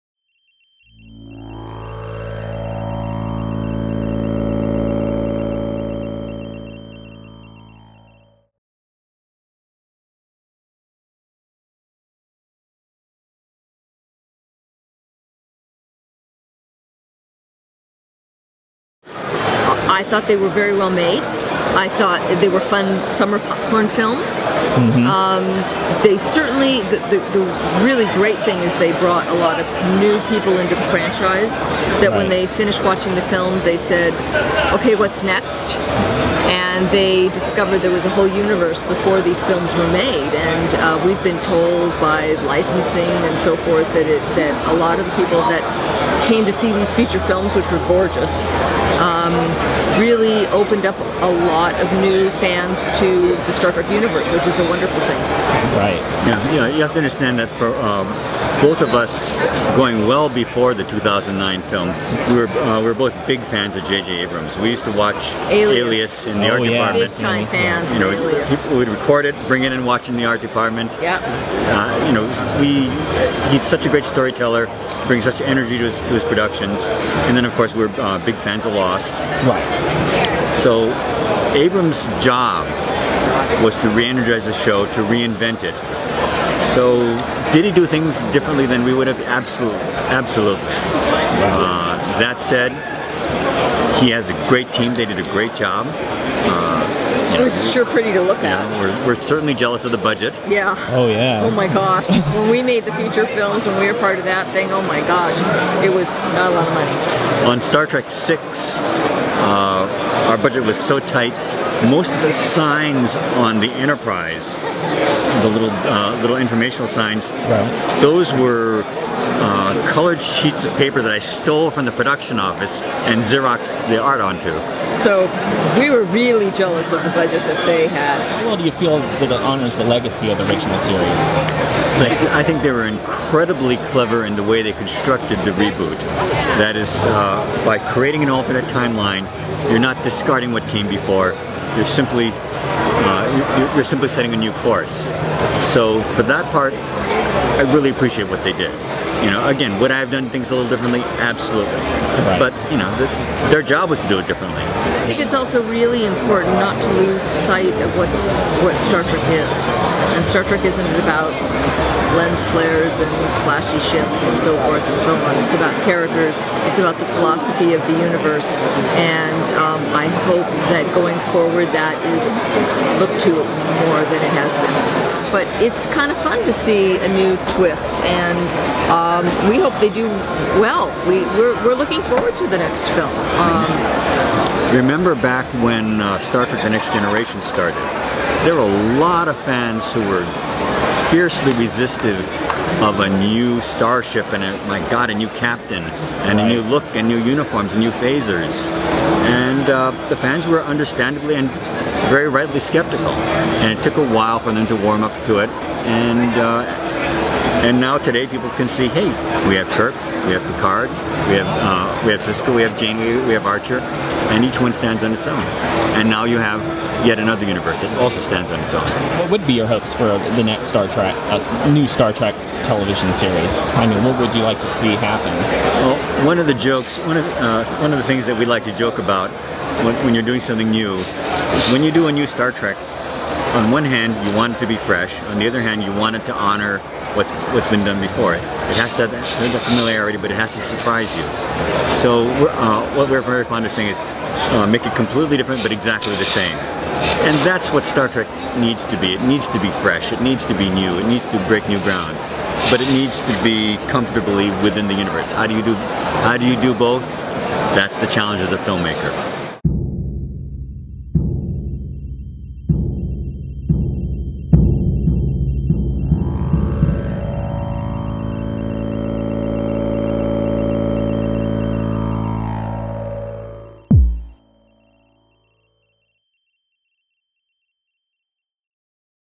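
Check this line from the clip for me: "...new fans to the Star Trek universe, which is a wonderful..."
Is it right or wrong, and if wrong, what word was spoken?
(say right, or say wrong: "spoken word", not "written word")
right.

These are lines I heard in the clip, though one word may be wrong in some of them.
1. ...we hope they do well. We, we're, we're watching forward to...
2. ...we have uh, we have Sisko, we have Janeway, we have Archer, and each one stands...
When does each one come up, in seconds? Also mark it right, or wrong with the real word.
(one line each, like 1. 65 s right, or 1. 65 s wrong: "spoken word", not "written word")
1. 179 s wrong: "looking", not "watching"
2. 211 s right.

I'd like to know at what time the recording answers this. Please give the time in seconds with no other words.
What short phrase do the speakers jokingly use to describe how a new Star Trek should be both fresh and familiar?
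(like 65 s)
244 s.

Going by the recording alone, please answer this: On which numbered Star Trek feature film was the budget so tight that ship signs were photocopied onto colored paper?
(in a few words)
Star Trek Six.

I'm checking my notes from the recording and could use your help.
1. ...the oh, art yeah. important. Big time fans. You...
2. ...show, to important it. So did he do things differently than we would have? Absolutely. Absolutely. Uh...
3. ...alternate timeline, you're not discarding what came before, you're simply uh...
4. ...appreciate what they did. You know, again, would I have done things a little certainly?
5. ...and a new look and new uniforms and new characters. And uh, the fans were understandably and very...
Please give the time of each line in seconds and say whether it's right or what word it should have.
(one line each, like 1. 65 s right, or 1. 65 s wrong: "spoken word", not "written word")
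1. 66 s wrong: "department", not "important"
2. 84 s wrong: "reinvent", not "important"
3. 138 s right
4. 147 s wrong: "differently", not "certainly"
5. 196 s wrong: "phasers", not "characters".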